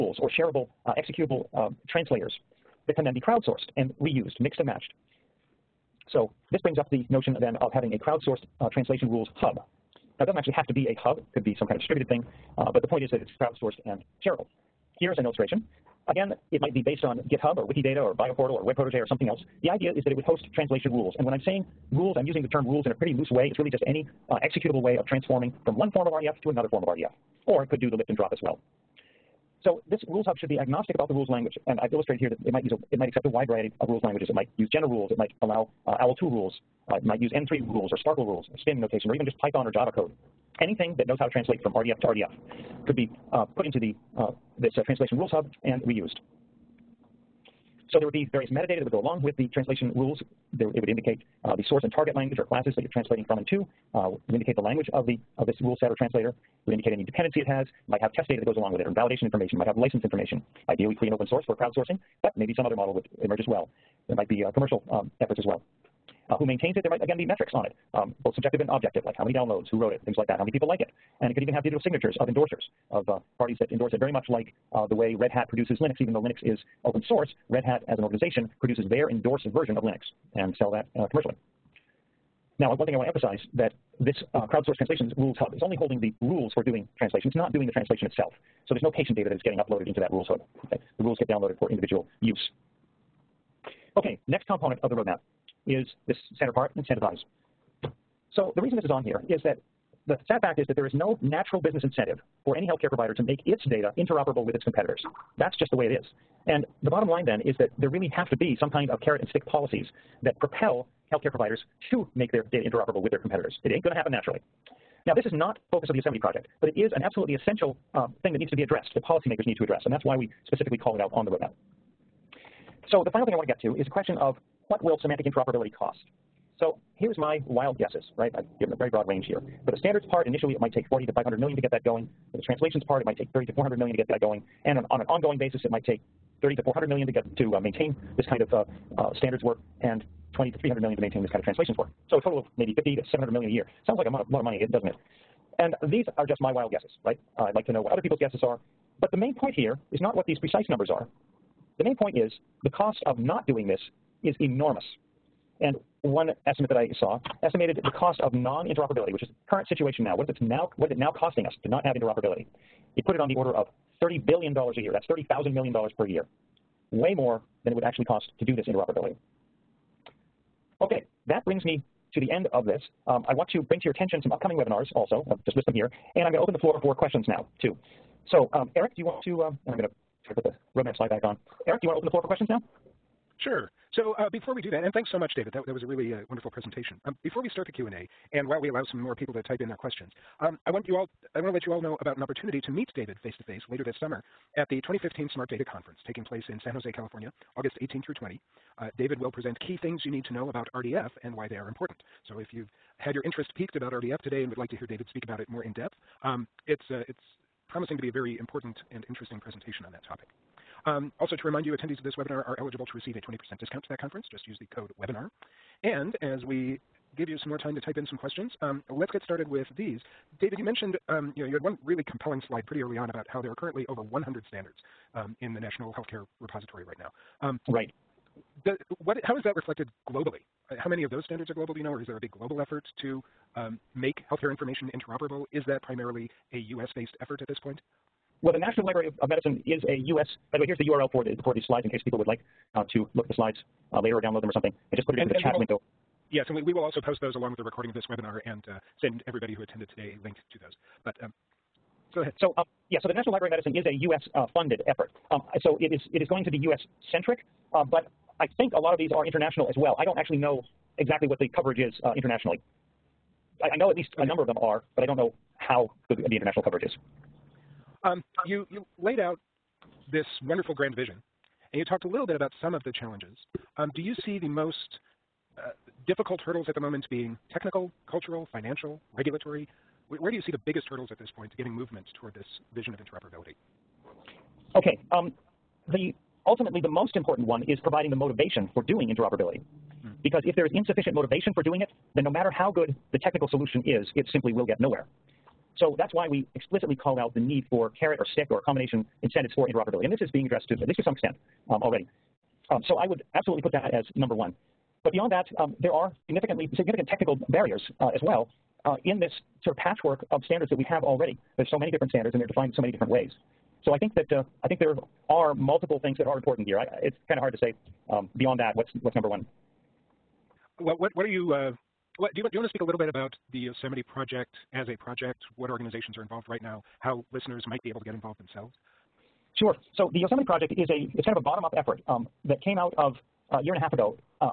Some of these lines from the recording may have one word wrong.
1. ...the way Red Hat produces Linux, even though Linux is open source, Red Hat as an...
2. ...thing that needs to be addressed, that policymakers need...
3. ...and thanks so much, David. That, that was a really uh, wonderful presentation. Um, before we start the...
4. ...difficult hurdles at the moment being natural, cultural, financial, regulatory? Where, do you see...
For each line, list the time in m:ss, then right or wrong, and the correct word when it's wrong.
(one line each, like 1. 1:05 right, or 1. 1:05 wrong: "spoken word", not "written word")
1. 1:14 right
2. 1:58 right
3. 3:04 right
4. 4:36 wrong: "technical", not "natural".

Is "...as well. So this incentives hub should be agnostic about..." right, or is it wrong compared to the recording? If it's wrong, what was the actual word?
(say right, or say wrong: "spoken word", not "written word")
wrong: "rules", not "incentives".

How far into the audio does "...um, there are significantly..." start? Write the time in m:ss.
5:05.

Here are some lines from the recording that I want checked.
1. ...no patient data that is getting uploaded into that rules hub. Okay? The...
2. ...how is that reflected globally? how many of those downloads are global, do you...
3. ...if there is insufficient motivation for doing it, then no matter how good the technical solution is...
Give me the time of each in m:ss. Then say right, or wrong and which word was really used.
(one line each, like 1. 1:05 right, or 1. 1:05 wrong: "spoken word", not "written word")
1. 1:28 right
2. 3:49 wrong: "standards", not "downloads"
3. 4:50 right.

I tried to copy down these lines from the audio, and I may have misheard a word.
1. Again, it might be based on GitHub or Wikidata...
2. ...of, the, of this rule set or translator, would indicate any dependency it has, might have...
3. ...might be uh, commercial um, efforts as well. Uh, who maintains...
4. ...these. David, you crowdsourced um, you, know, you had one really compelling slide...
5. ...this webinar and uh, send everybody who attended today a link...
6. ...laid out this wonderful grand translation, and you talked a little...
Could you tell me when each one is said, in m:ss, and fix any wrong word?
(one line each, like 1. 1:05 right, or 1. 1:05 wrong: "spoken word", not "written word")
1. 0:16 right
2. 0:54 right
3. 1:04 right
4. 3:39 wrong: "mentioned", not "crowdsourced"
5. 4:07 right
6. 4:29 wrong: "vision", not "translation".